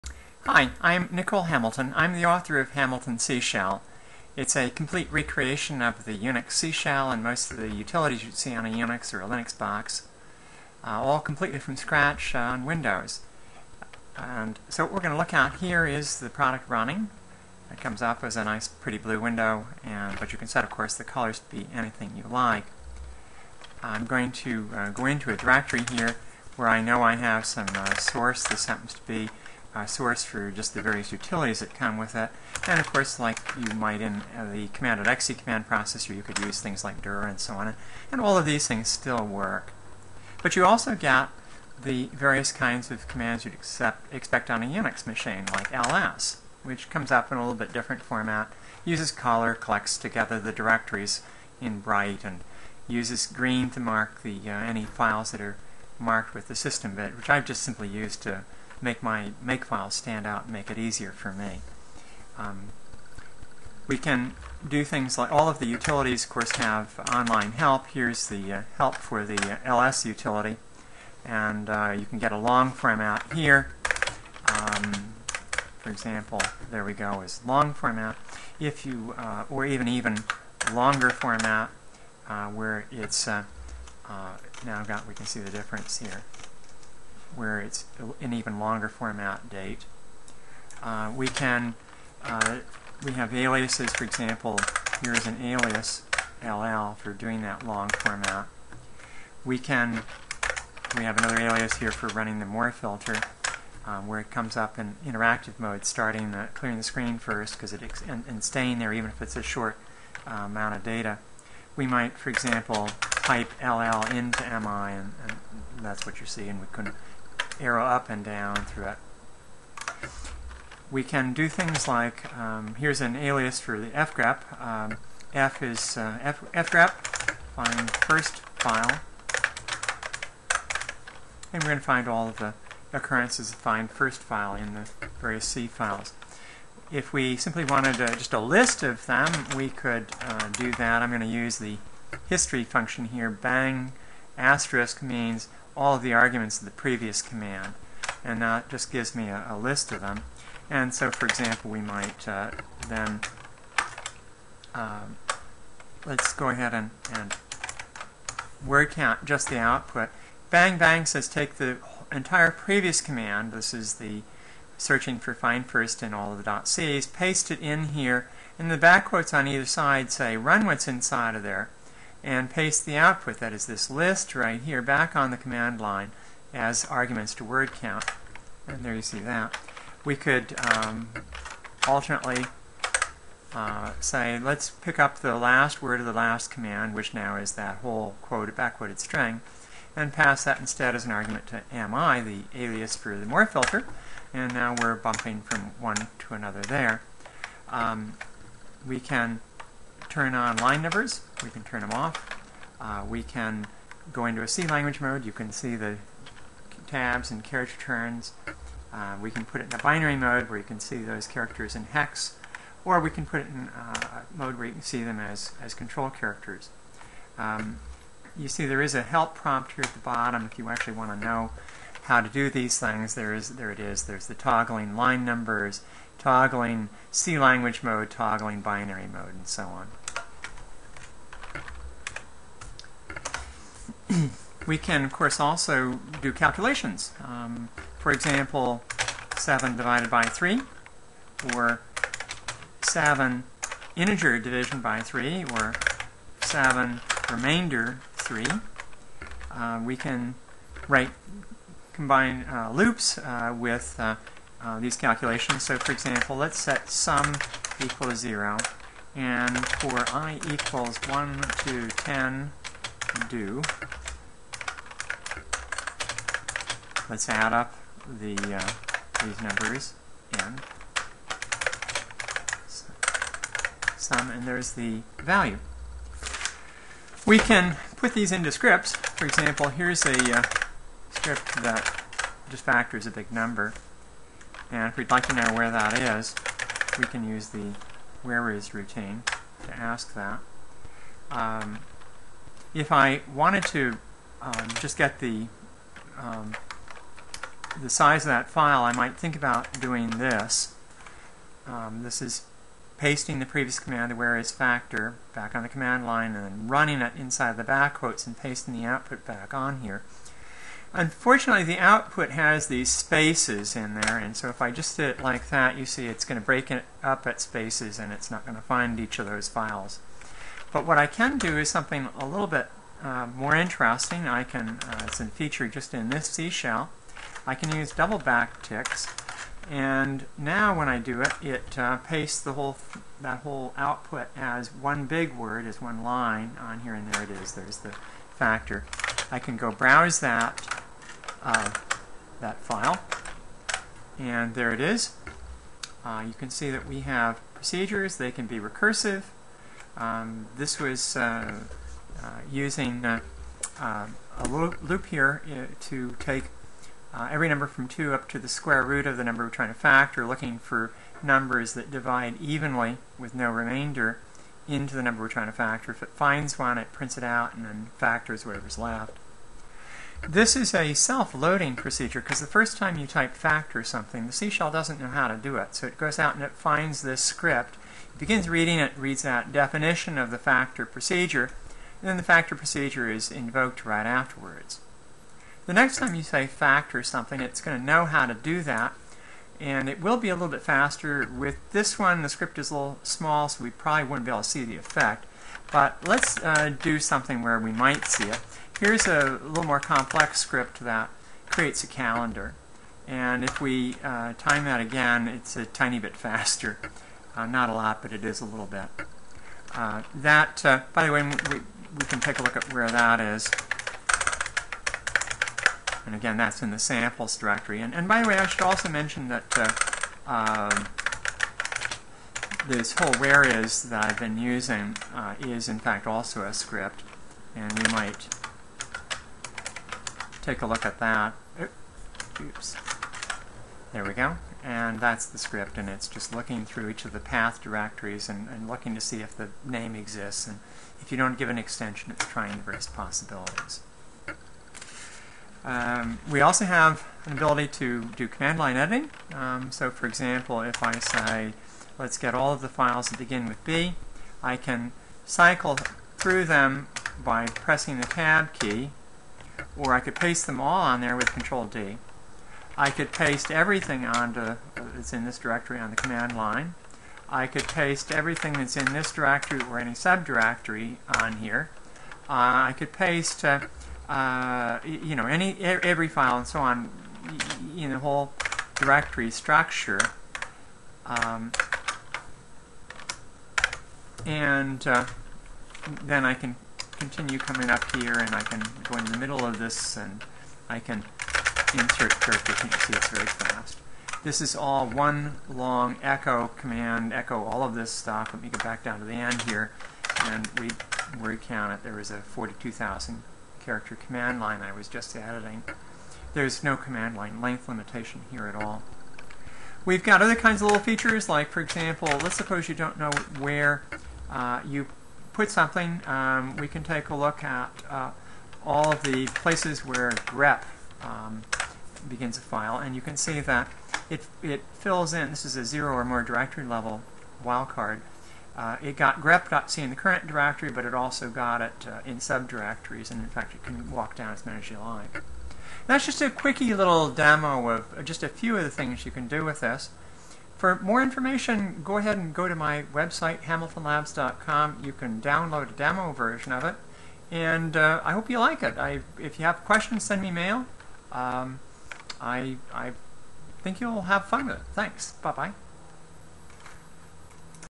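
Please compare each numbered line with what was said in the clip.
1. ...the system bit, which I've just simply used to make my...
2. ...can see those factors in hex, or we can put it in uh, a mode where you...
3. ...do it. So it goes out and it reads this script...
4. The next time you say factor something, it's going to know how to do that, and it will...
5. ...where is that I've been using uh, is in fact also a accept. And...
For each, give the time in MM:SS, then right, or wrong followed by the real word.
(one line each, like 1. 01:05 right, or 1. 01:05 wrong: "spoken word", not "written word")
1. 00:56 right
2. 03:30 wrong: "characters", not "factors"
3. 06:15 wrong: "finds", not "reads"
4. 06:25 right
5. 07:03 wrong: "script", not "accept".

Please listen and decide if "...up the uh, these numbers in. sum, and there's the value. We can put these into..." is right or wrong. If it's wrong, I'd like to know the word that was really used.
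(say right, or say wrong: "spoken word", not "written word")
right.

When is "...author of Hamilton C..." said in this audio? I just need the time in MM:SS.
00:02.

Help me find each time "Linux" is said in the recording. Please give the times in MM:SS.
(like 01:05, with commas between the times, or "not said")
00:09.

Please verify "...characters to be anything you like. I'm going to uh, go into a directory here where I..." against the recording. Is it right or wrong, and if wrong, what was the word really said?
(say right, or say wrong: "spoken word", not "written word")
wrong: "colors", not "characters".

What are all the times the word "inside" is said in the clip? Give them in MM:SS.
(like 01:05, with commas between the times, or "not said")
02:50, 05:07.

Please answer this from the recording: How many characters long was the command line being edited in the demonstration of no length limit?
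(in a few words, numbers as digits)
42,000.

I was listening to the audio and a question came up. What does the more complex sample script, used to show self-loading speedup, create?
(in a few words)
a calendar.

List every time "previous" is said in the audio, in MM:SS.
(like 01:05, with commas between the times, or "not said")
02:26, 02:42, 05:03.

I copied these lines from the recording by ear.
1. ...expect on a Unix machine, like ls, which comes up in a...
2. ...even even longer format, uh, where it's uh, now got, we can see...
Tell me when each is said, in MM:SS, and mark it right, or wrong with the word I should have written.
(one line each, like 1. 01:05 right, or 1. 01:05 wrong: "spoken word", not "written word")
1. 00:44 right
2. 01:19 right.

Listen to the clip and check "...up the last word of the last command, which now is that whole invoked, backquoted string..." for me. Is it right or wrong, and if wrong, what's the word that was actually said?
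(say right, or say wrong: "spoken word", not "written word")
wrong: "quoted", not "invoked".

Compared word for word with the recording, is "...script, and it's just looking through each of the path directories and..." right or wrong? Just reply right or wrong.
right.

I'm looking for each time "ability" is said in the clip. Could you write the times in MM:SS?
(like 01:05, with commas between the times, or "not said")
07:27.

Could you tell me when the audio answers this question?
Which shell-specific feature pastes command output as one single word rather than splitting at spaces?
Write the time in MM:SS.
05:27.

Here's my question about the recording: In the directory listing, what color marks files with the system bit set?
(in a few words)
Green.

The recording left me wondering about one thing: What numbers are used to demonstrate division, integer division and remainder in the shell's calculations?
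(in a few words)
7 and 3.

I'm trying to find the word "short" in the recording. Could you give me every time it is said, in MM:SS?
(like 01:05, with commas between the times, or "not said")
01:49.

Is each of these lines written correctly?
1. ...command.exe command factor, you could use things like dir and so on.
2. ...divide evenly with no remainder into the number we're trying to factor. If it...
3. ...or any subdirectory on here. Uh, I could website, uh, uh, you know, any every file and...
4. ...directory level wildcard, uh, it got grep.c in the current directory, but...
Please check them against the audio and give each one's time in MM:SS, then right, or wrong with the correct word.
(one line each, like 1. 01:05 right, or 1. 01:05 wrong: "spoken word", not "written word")
1. 00:34 wrong: "processor", not "factor"
2. 06:01 right
3. 07:49 wrong: "paste", not "website"
4. 08:46 right.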